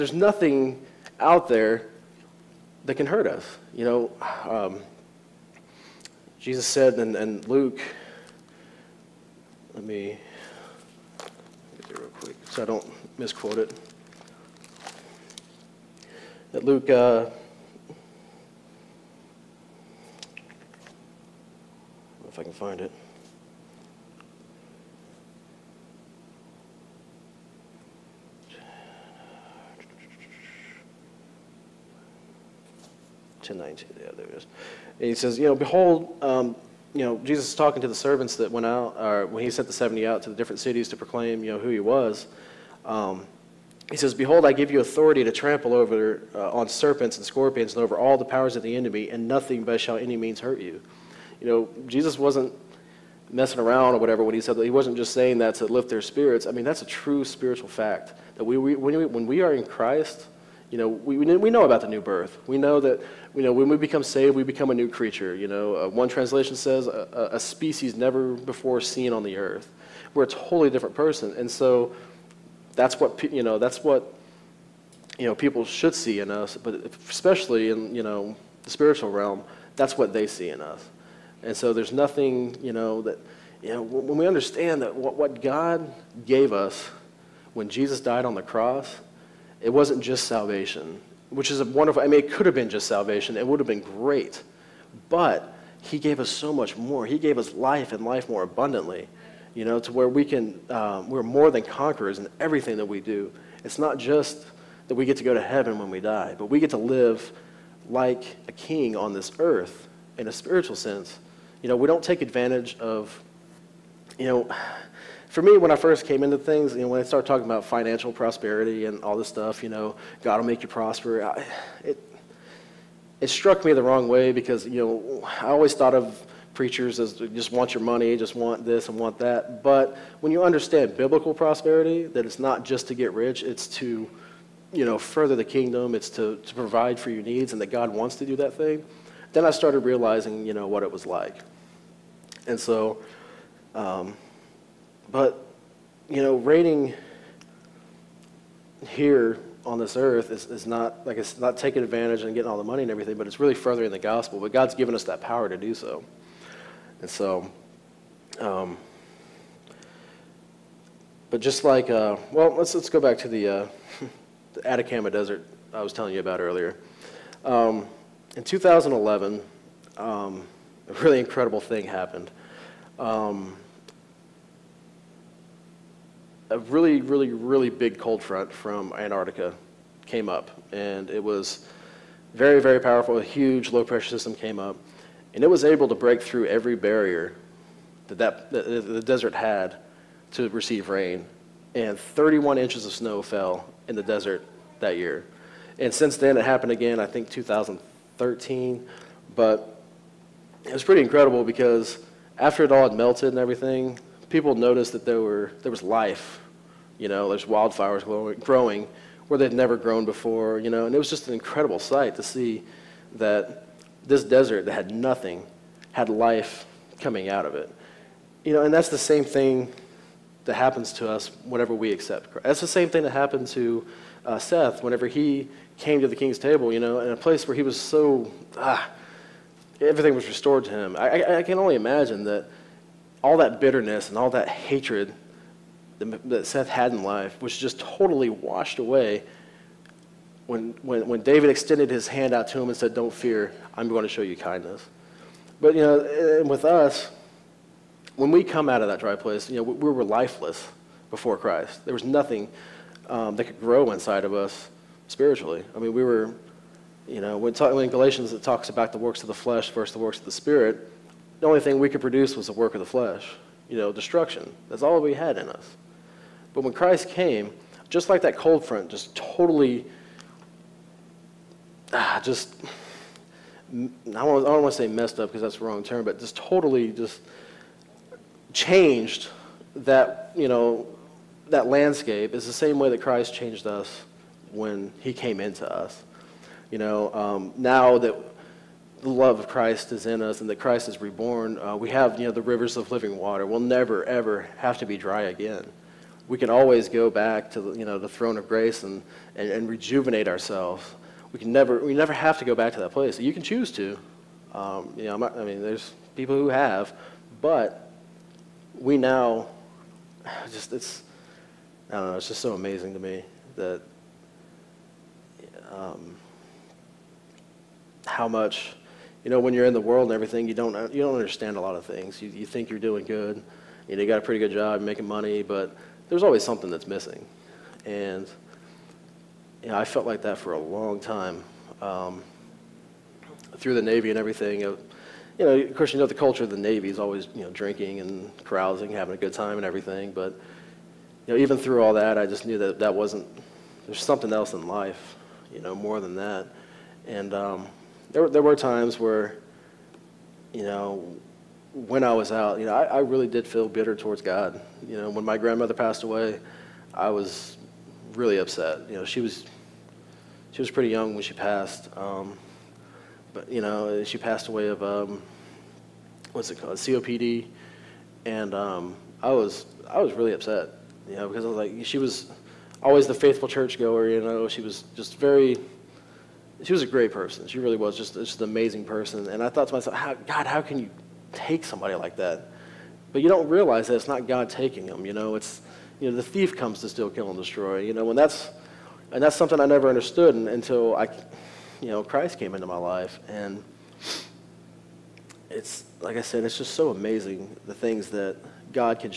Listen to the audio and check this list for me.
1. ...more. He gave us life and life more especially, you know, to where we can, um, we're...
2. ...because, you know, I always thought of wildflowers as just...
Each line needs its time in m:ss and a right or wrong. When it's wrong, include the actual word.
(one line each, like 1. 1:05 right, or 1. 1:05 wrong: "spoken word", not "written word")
1. 1:36 wrong: "abundantly", not "especially"
2. 2:04 wrong: "preachers", not "wildflowers".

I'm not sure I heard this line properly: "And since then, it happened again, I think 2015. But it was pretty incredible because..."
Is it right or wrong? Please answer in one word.
wrong.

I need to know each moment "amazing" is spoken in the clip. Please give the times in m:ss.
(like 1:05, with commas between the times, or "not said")
5:12, 6:18, 6:36.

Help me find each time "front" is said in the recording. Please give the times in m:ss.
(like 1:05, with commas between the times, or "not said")
2:58, 4:28.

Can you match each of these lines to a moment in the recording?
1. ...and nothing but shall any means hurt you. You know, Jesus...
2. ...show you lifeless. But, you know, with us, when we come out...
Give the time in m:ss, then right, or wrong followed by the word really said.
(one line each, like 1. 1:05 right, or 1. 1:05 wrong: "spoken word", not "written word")
1. 0:49 right
2. 4:04 wrong: "kindness", not "lifeless".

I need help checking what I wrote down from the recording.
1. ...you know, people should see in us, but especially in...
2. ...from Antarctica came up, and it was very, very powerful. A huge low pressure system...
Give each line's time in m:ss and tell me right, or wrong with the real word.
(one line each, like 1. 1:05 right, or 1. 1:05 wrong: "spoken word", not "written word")
1. 1:15 right
2. 2:58 right.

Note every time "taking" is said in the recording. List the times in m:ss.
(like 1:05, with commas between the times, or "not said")
2:31, 6:24.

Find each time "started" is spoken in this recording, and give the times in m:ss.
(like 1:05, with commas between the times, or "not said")
1:57, 2:19.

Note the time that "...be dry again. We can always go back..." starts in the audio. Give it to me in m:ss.
4:54.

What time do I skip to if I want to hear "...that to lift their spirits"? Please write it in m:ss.
0:55.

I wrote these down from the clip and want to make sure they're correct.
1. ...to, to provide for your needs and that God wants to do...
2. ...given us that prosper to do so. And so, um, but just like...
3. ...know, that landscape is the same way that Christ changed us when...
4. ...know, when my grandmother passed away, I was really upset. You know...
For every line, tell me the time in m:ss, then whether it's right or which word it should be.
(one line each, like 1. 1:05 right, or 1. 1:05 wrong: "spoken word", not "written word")
1. 2:16 right
2. 2:34 wrong: "power", not "prosper"
3. 4:40 right
4. 5:54 right.